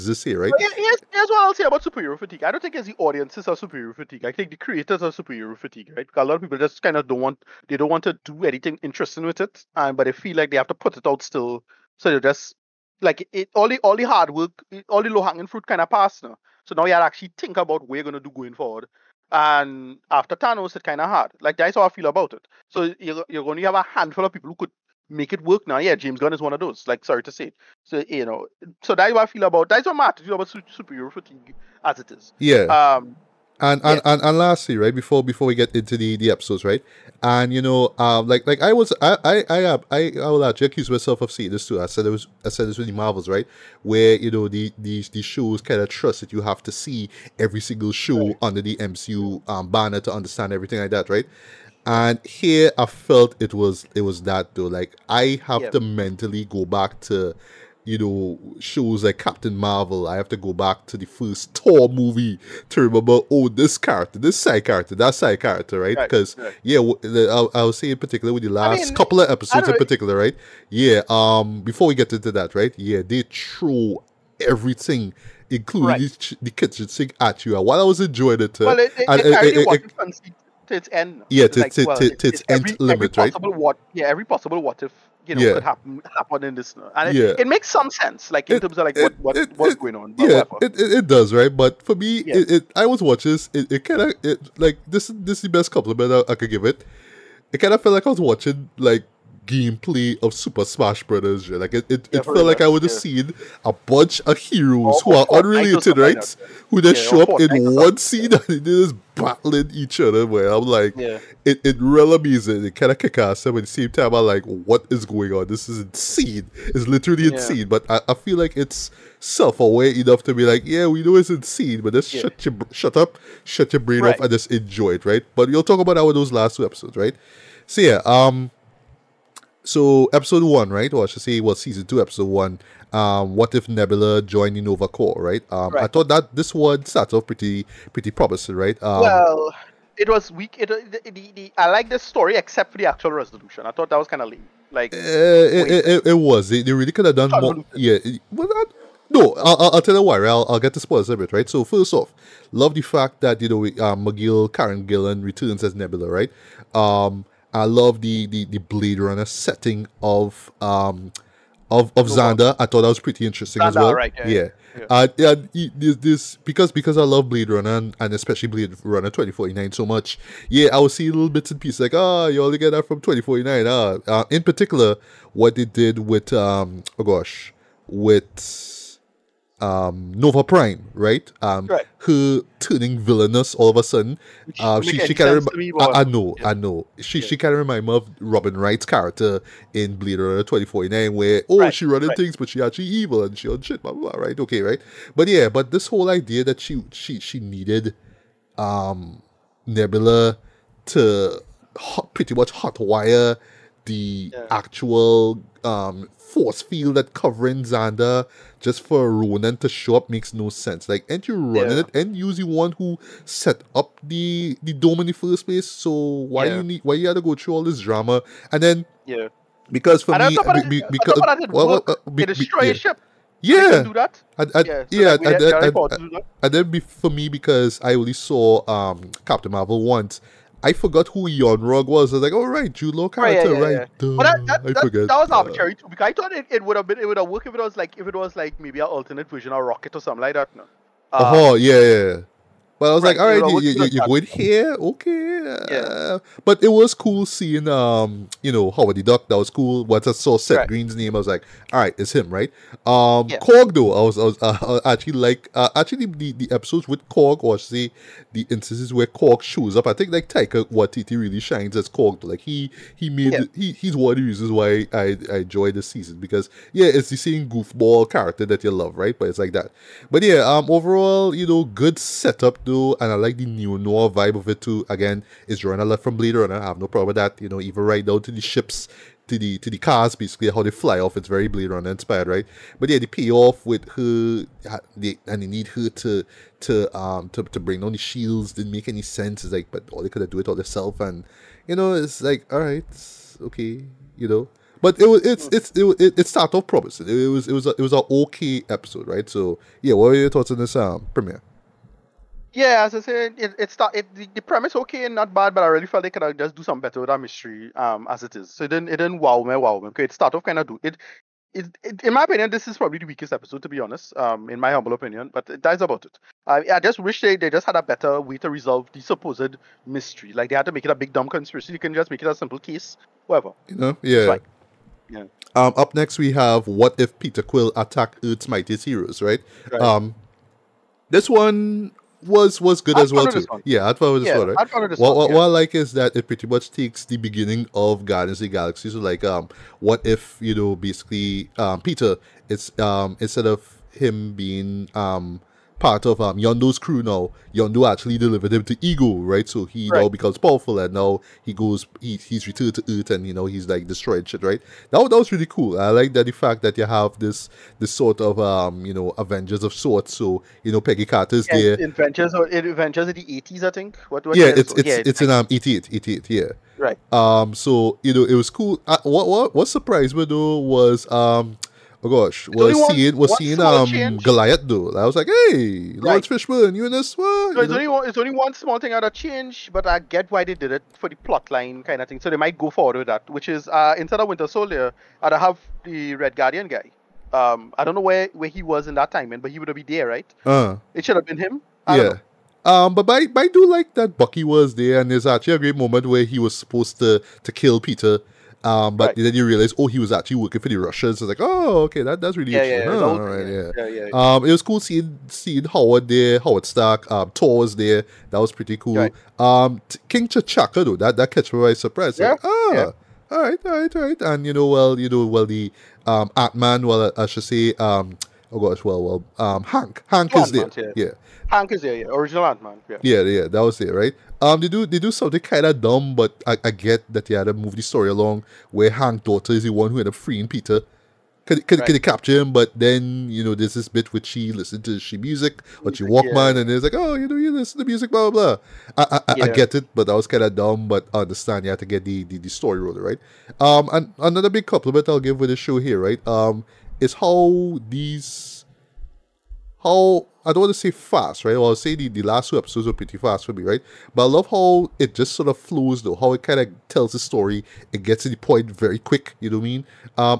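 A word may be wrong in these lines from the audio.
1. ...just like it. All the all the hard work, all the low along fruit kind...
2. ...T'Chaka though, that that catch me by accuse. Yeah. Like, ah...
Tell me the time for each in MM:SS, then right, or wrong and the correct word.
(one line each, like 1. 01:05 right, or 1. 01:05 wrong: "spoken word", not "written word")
1. 00:12 wrong: "hanging", not "along"
2. 06:50 wrong: "surprise", not "accuse".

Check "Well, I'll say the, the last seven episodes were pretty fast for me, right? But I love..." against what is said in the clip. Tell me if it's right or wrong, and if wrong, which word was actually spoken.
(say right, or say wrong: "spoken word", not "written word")
wrong: "two", not "seven".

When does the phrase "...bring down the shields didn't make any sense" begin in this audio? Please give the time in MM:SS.
04:47.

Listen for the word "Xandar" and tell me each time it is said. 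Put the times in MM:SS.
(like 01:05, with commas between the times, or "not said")
02:42, 03:27.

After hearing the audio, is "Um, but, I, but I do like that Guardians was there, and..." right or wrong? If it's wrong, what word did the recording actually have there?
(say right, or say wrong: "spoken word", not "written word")
wrong: "Bucky", not "Guardians".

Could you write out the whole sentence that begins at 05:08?
So it didn't it didn't wow me, wow me.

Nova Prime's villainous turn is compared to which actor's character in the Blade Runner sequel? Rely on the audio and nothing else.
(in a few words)
Robin Wright.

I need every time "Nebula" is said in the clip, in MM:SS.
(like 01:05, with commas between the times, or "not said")
02:13, 02:35, 03:19.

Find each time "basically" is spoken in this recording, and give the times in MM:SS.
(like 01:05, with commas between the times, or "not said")
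04:40, 05:40.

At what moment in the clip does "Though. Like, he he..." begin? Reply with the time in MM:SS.
04:22.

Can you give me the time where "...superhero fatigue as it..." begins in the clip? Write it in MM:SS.
00:30.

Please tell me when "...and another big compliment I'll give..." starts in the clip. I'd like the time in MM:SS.
07:23.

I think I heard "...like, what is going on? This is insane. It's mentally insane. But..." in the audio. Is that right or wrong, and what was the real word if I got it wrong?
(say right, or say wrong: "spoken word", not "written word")
wrong: "literally", not "mentally".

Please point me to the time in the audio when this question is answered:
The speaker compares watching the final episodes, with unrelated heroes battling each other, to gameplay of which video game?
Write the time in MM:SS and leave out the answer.
01:40.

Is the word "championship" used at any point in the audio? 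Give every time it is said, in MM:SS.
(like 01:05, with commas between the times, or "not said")
not said.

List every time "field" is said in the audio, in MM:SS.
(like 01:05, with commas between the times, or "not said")
03:26.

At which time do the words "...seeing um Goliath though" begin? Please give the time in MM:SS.
06:13.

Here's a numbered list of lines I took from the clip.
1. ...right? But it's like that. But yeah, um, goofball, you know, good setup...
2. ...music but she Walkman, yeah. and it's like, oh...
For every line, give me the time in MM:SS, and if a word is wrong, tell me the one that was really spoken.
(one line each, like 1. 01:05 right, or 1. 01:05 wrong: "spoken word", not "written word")
1. 04:28 wrong: "overall", not "goofball"
2. 07:15 right.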